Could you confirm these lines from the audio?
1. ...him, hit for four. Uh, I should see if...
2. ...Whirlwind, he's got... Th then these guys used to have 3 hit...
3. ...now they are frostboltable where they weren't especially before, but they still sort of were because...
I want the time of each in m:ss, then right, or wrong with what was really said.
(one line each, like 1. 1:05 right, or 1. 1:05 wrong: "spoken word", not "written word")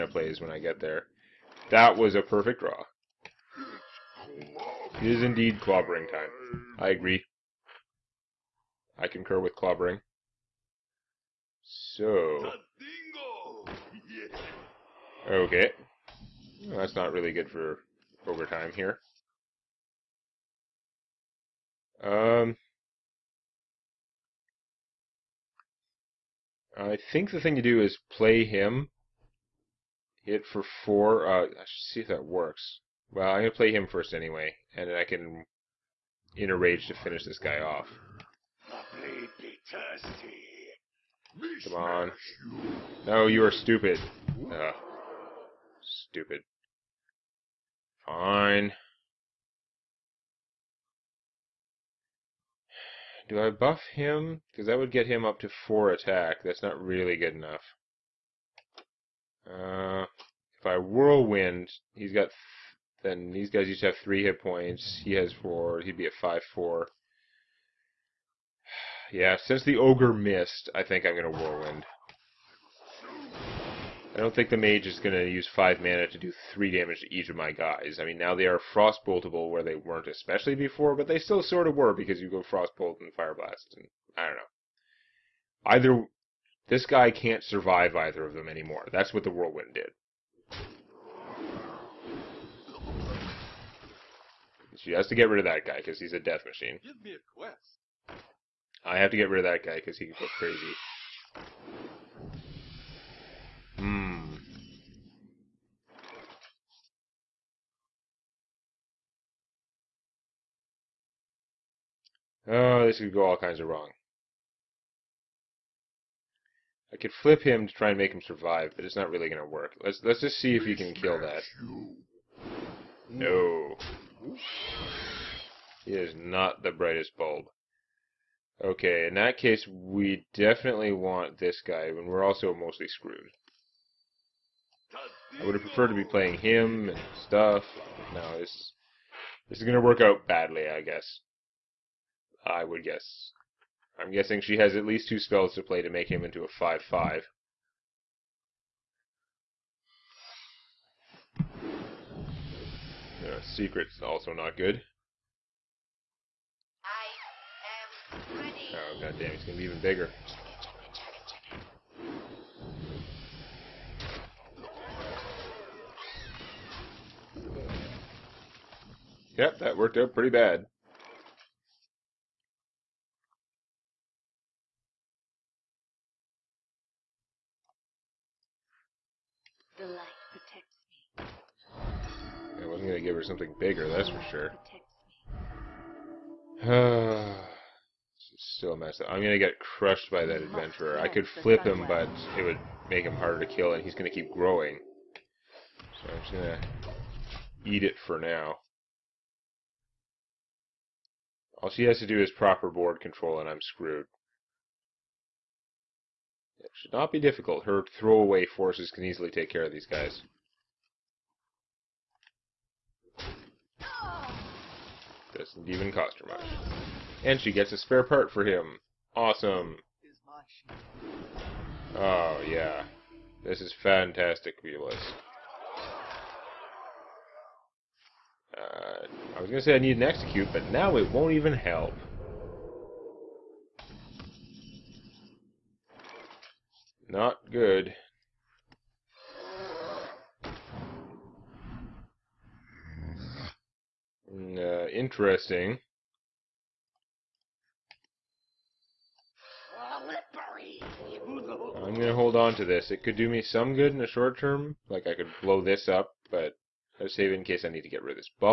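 1. 0:28 right
2. 1:00 right
3. 1:18 right.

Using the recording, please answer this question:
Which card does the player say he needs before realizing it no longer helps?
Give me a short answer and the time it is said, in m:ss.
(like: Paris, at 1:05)
Execute, at 3:50.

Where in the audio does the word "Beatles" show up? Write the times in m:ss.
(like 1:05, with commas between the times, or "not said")
3:44.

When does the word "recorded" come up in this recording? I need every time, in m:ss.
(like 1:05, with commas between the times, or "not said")
not said.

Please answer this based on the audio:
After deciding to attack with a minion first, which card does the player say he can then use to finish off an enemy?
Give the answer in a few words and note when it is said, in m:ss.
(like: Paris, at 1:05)
Inner Rage, at 0:36.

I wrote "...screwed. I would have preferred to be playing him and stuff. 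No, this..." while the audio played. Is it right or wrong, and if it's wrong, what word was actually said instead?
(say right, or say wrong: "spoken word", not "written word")
right.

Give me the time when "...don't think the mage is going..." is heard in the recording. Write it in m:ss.
1:14.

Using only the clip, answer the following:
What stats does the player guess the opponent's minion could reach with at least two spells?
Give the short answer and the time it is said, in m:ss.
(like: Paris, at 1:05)
5/5, at 2:26.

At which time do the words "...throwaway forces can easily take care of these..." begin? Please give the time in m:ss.
3:27.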